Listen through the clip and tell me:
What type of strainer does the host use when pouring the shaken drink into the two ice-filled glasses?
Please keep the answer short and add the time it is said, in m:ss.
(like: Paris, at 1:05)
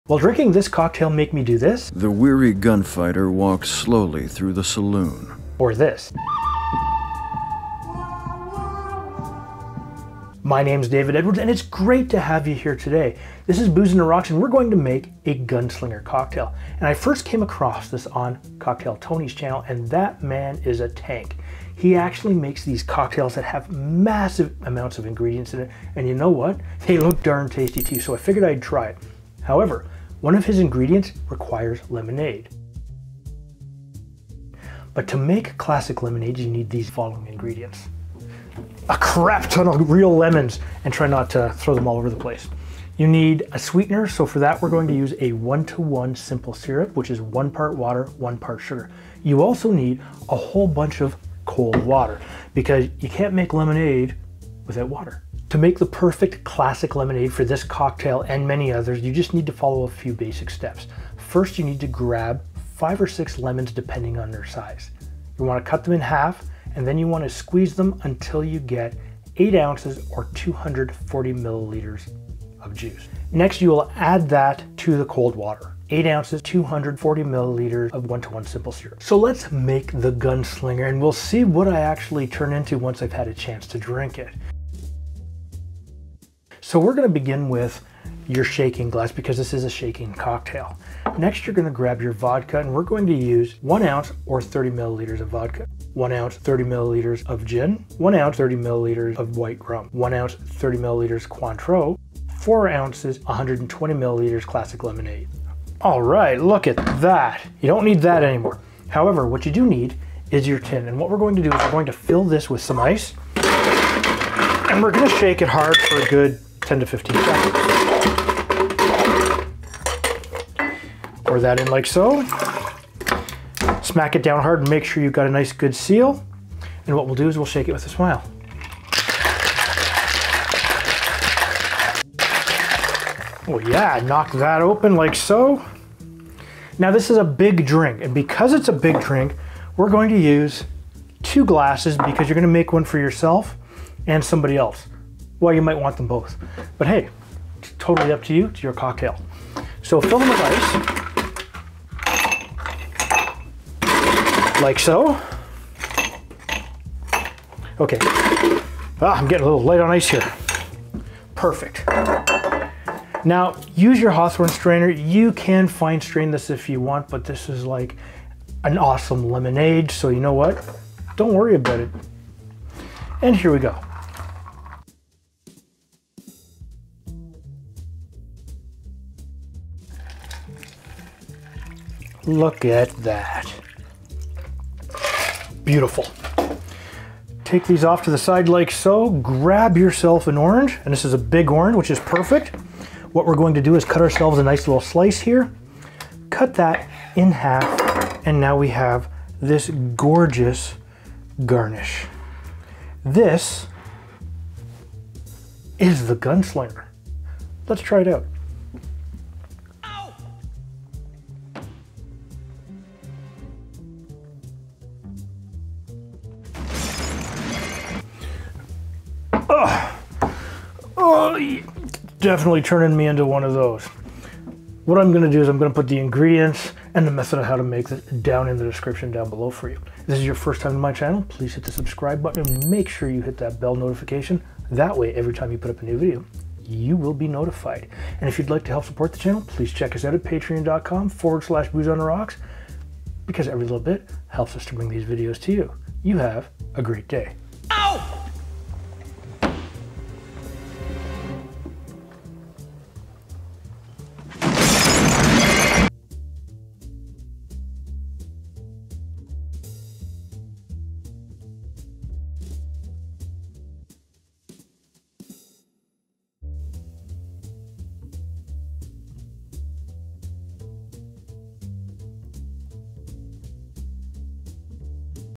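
Hawthorne strainer, at 2:44.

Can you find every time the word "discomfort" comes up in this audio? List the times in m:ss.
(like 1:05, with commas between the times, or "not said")
not said.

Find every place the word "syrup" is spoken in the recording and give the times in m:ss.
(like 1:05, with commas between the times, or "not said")
0:46, 1:18.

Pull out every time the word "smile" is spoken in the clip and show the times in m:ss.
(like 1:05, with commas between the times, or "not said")
2:07.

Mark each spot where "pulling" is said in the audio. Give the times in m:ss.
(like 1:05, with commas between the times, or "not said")
not said.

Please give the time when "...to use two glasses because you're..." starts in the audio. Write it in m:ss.
2:20.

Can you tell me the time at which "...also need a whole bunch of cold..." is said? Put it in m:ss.
0:49.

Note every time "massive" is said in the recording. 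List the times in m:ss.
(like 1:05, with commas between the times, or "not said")
0:23.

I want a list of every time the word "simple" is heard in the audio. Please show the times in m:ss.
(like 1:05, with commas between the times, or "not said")
0:46, 1:18.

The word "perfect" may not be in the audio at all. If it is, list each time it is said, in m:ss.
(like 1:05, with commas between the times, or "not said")
0:55, 2:41, 3:11.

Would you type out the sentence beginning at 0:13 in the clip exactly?
This is Booze and Rocks, and we're going to make a gunslinger cocktail.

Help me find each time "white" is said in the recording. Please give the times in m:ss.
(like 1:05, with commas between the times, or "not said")
1:39.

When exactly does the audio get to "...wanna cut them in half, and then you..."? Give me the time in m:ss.
1:05.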